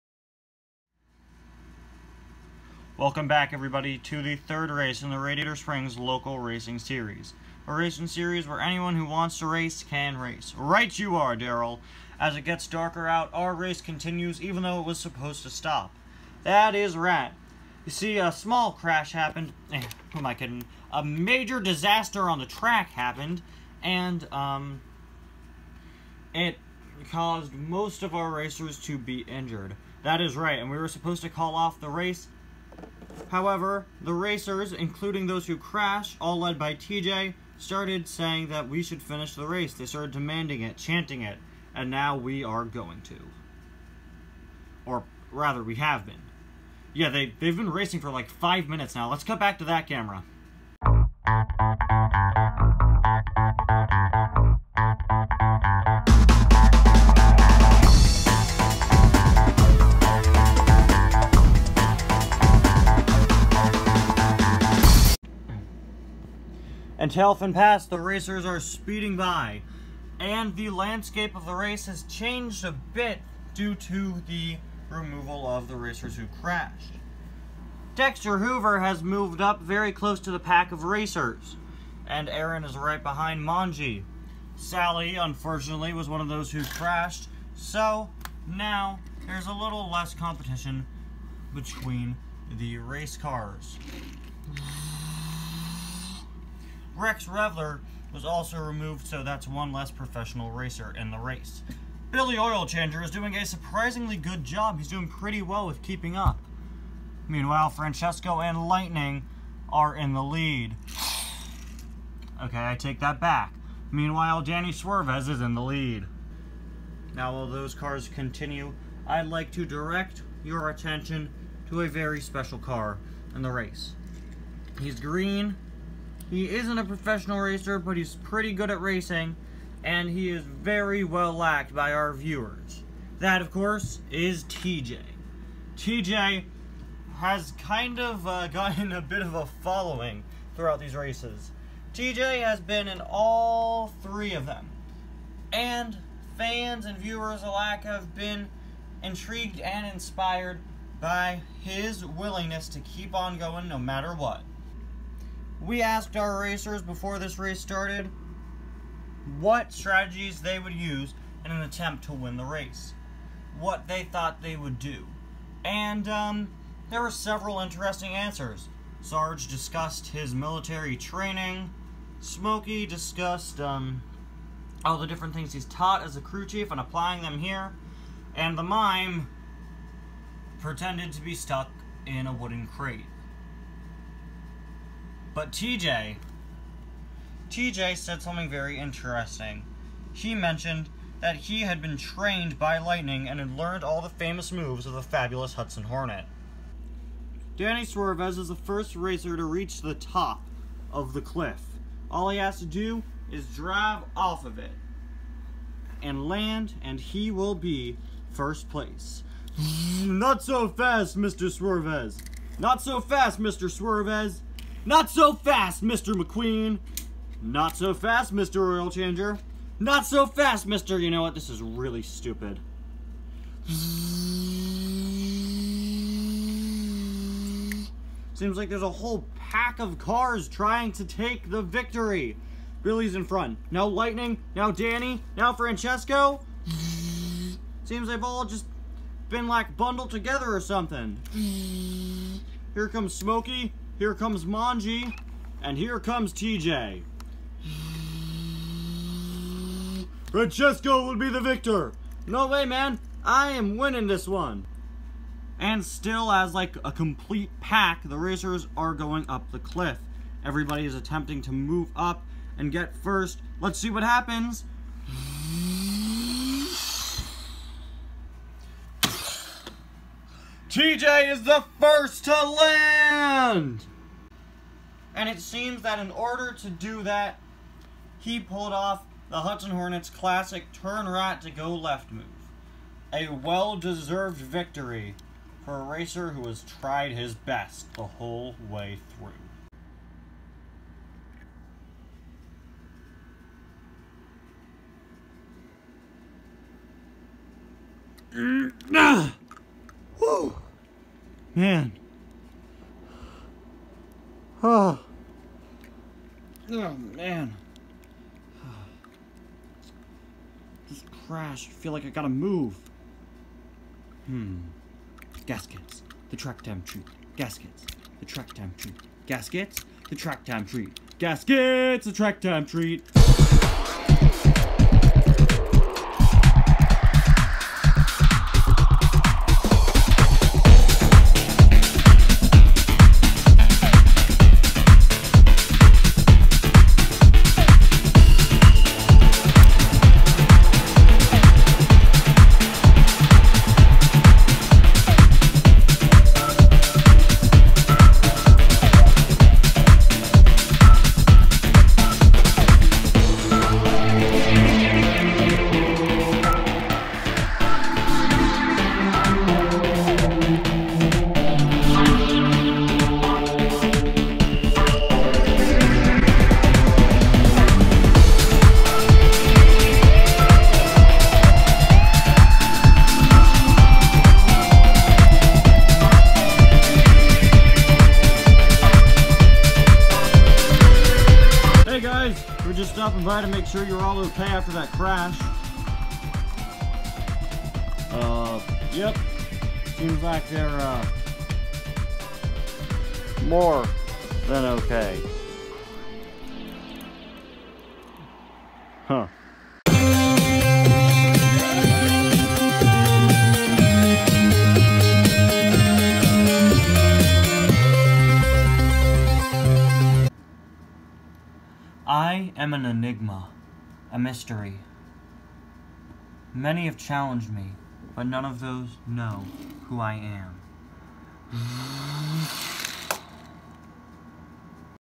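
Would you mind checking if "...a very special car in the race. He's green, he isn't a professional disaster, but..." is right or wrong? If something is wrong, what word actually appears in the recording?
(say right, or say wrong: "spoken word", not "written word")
wrong: "racer", not "disaster".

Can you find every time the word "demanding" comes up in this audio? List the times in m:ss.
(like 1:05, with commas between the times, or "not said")
0:40.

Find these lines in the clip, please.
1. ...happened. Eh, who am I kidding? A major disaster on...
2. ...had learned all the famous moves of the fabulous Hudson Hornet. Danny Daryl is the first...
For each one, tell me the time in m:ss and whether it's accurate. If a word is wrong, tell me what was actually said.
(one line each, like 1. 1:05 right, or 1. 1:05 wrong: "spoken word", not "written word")
1. 0:19 right
2. 3:13 wrong: "Swervez", not "Daryl".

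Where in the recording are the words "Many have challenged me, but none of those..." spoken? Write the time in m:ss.
6:56.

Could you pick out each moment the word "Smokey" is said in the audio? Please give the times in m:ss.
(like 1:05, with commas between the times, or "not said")
2:52, 4:03.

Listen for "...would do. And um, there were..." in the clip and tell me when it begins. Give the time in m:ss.
2:44.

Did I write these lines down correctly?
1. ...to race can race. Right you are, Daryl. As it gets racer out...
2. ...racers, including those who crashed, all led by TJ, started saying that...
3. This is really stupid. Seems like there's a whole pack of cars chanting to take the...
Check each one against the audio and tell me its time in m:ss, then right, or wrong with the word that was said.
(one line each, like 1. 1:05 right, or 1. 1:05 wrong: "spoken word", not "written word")
1. 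0:09 wrong: "darker", not "racer"
2. 0:34 right
3. 3:41 wrong: "trying", not "chanting".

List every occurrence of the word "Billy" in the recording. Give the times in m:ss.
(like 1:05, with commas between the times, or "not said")
1:42, 3:52.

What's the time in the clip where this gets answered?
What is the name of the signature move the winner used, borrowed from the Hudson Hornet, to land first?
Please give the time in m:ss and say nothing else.
4:40.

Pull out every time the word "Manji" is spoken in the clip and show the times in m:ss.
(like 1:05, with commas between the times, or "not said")
1:23, 4:04.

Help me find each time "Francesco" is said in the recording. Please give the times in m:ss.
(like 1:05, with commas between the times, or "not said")
1:47, 3:55, 4:10.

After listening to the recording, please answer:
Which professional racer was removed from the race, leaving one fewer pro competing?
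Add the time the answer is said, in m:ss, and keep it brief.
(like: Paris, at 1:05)
Rex Revler, at 1:37.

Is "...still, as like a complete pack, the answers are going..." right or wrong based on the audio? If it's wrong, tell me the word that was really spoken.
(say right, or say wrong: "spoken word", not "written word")
wrong: "racers", not "answers".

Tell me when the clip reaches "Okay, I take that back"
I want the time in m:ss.
1:52.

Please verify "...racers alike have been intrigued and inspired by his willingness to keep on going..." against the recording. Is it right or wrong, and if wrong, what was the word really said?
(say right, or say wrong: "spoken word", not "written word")
wrong: "viewers", not "racers".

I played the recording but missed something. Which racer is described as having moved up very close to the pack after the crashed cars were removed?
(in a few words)
Dexter Hoover.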